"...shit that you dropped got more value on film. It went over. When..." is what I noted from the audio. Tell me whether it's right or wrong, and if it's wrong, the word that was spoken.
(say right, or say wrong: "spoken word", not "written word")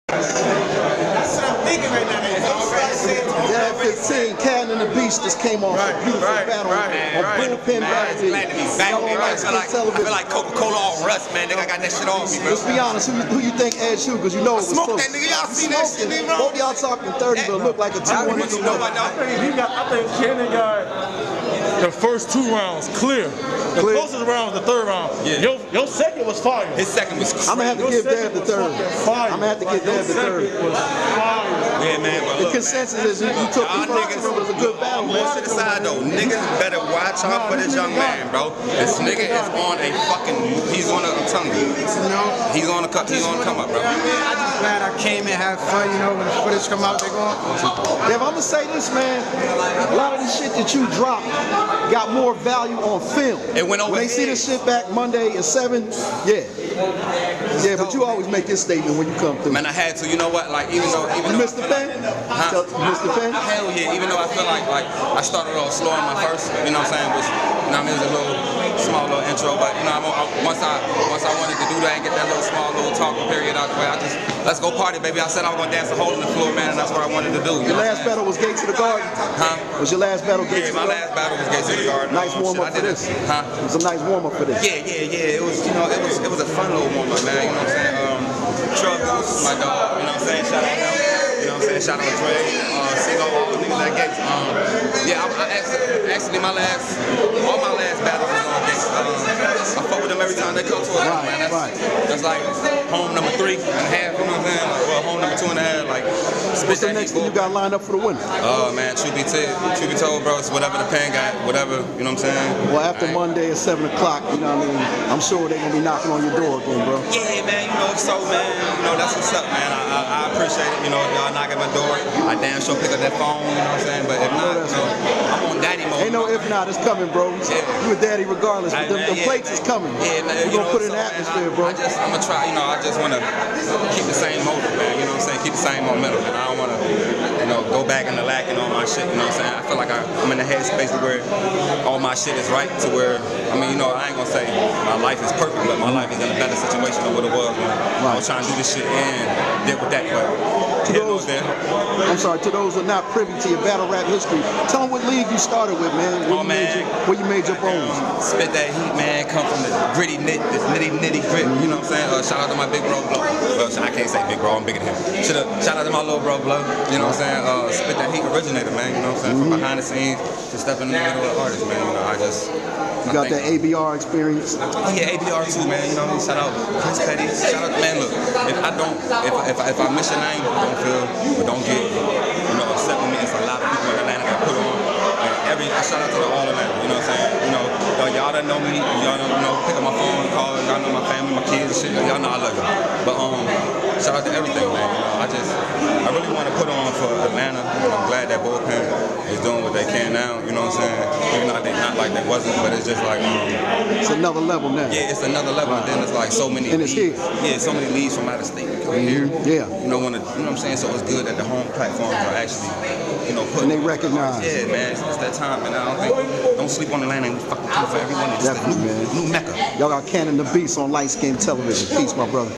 right.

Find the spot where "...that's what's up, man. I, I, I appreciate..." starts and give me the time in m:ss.
1:58.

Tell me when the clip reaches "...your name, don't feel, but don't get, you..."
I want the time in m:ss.
3:00.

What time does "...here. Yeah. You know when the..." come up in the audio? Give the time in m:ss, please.
3:29.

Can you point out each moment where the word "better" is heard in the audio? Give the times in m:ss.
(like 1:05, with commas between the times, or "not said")
0:36, 2:26.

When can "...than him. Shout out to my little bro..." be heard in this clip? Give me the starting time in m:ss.
2:44.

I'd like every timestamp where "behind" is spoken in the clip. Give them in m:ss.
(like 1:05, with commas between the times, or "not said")
2:49.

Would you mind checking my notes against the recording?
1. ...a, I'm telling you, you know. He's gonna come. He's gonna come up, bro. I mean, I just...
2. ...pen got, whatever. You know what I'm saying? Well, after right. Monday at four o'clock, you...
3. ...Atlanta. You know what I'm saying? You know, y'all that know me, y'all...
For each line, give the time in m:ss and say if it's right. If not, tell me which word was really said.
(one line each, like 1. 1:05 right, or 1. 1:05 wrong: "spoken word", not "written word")
1. 0:41 right
2. 1:50 wrong: "seven", not "four"
3. 3:06 right.